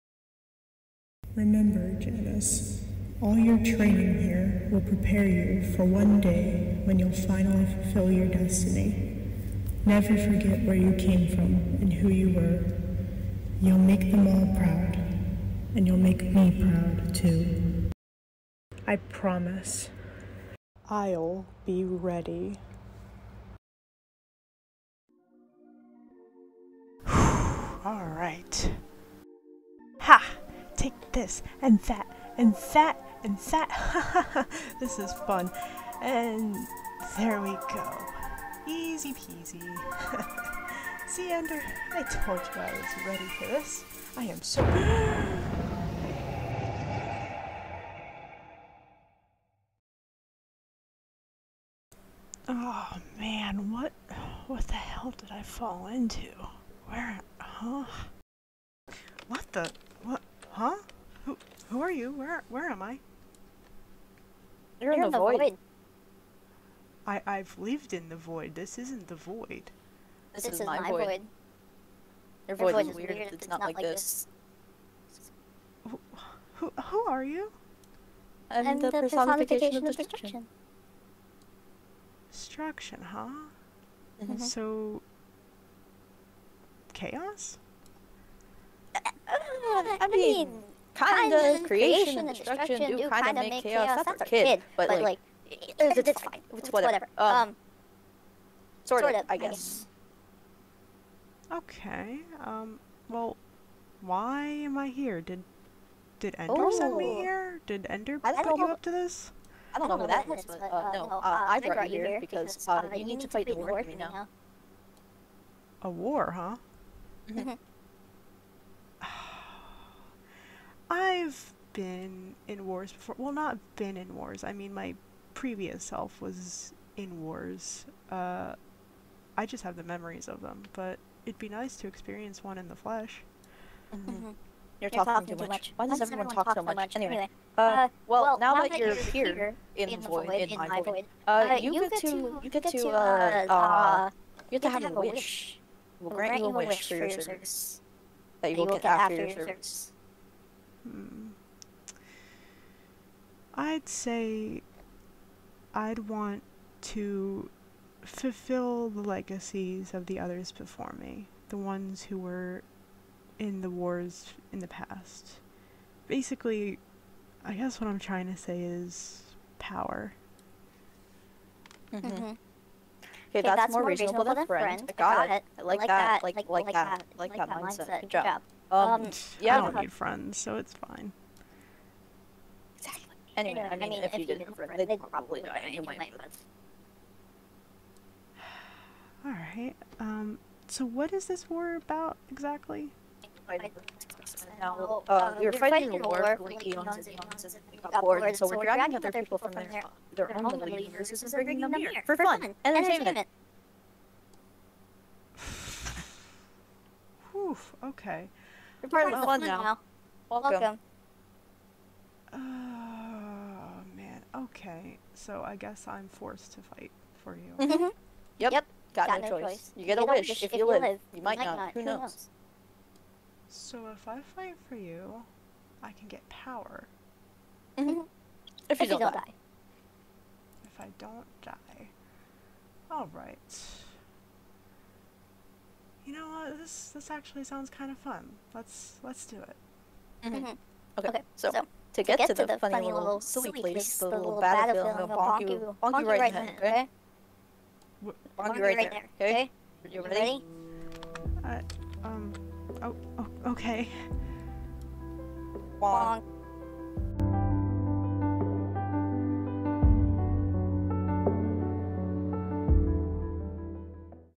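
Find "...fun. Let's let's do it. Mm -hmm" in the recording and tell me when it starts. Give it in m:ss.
3:57.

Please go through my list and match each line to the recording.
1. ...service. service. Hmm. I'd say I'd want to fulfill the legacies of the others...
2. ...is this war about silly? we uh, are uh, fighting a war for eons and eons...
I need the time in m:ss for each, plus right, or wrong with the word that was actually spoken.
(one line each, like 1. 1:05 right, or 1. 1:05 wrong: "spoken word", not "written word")
1. 2:29 right
2. 3:11 wrong: "exactly", not "silly".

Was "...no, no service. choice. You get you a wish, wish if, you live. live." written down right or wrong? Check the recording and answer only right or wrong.
wrong.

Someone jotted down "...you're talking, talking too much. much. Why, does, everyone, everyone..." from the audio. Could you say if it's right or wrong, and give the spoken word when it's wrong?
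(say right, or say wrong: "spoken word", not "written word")
right.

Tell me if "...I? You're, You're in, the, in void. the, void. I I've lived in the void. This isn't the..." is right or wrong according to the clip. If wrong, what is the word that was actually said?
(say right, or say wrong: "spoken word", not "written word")
right.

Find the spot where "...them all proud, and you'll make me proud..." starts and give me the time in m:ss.
0:14.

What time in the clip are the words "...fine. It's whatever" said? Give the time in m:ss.
1:36.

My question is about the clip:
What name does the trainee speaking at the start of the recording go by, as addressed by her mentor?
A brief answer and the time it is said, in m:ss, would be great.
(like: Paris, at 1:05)
Janice, at 0:01.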